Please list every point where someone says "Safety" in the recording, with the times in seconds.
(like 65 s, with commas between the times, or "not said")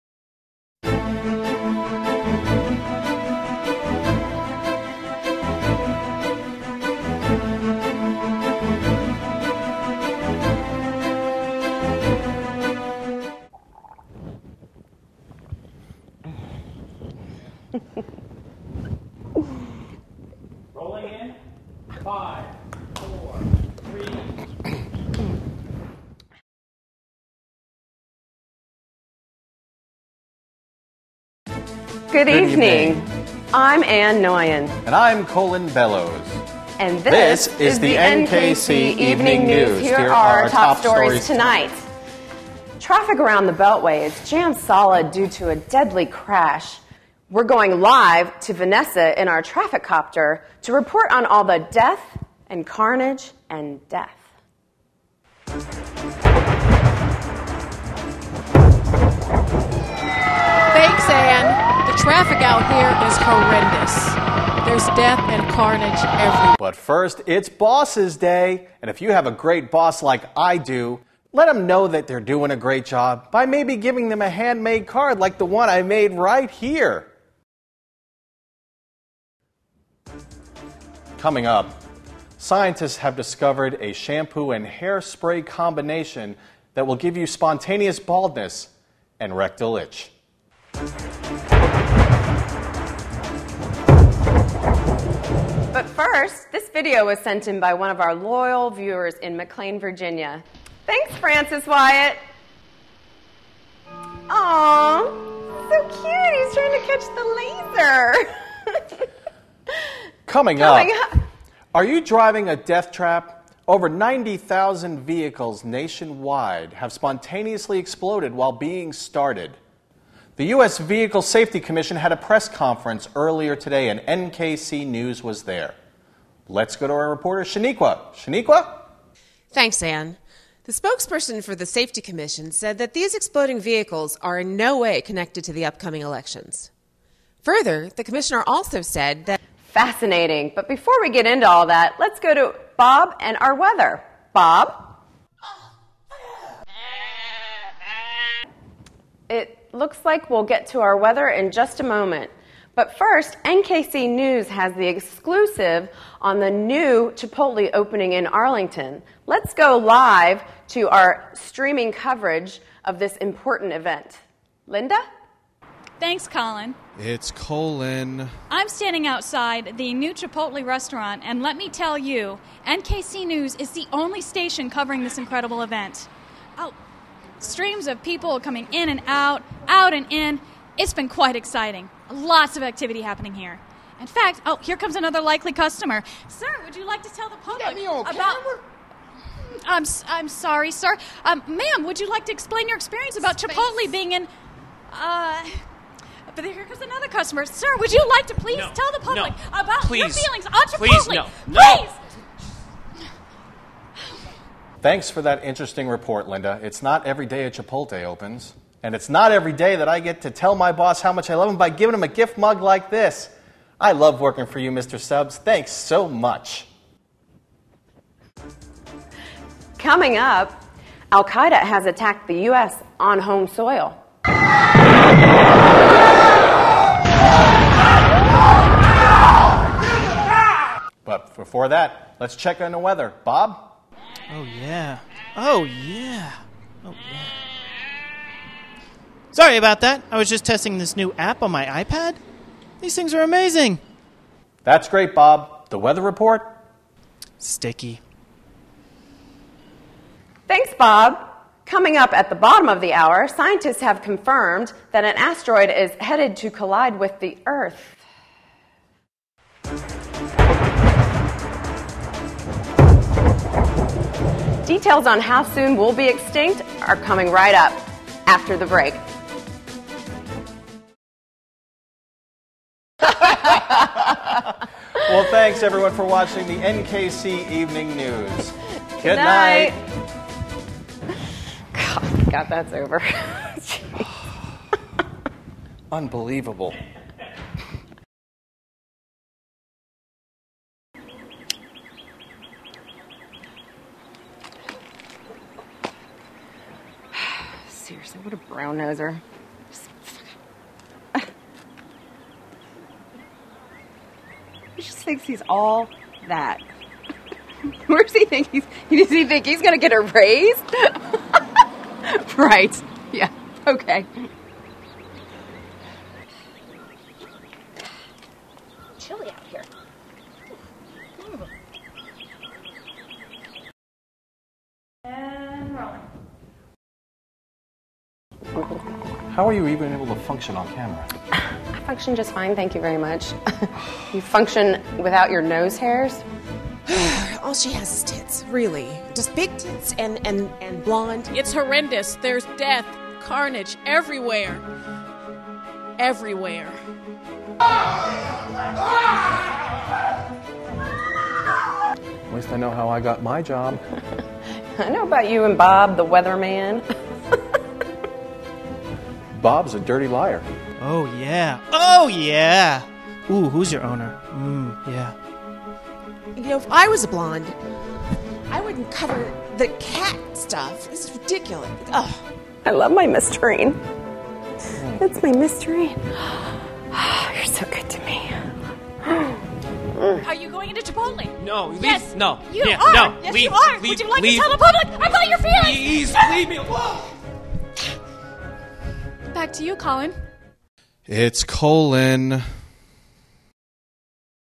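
121 s, 131 s.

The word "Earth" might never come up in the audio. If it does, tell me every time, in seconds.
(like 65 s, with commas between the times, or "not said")
257 s.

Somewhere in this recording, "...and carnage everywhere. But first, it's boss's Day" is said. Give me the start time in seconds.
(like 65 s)
65 s.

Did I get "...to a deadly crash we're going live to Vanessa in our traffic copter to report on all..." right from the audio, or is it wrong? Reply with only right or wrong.
right.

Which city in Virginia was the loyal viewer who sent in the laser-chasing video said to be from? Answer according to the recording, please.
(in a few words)
McLean.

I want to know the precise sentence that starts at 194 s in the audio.
Uh, but here comes another customer.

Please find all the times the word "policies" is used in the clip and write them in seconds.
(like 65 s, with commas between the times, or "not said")
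not said.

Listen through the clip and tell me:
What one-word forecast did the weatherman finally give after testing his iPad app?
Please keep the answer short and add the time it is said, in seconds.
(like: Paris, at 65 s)
Sticky, at 247 s.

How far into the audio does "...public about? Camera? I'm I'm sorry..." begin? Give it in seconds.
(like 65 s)
187 s.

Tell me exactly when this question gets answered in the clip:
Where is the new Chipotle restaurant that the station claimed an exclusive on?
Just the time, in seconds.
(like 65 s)
158 s.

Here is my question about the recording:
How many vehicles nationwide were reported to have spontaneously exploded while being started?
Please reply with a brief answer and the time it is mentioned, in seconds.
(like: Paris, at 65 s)
90,000, at 113 s.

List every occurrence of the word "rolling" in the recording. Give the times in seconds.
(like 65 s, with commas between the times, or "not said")
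20 s, 325 s.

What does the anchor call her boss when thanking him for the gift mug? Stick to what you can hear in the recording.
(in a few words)
Mr. Subs.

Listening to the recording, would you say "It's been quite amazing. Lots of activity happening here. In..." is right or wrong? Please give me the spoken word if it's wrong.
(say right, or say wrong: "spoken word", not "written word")
wrong: "exciting", not "amazing".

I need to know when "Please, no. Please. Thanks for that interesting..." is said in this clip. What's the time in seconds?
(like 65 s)
201 s.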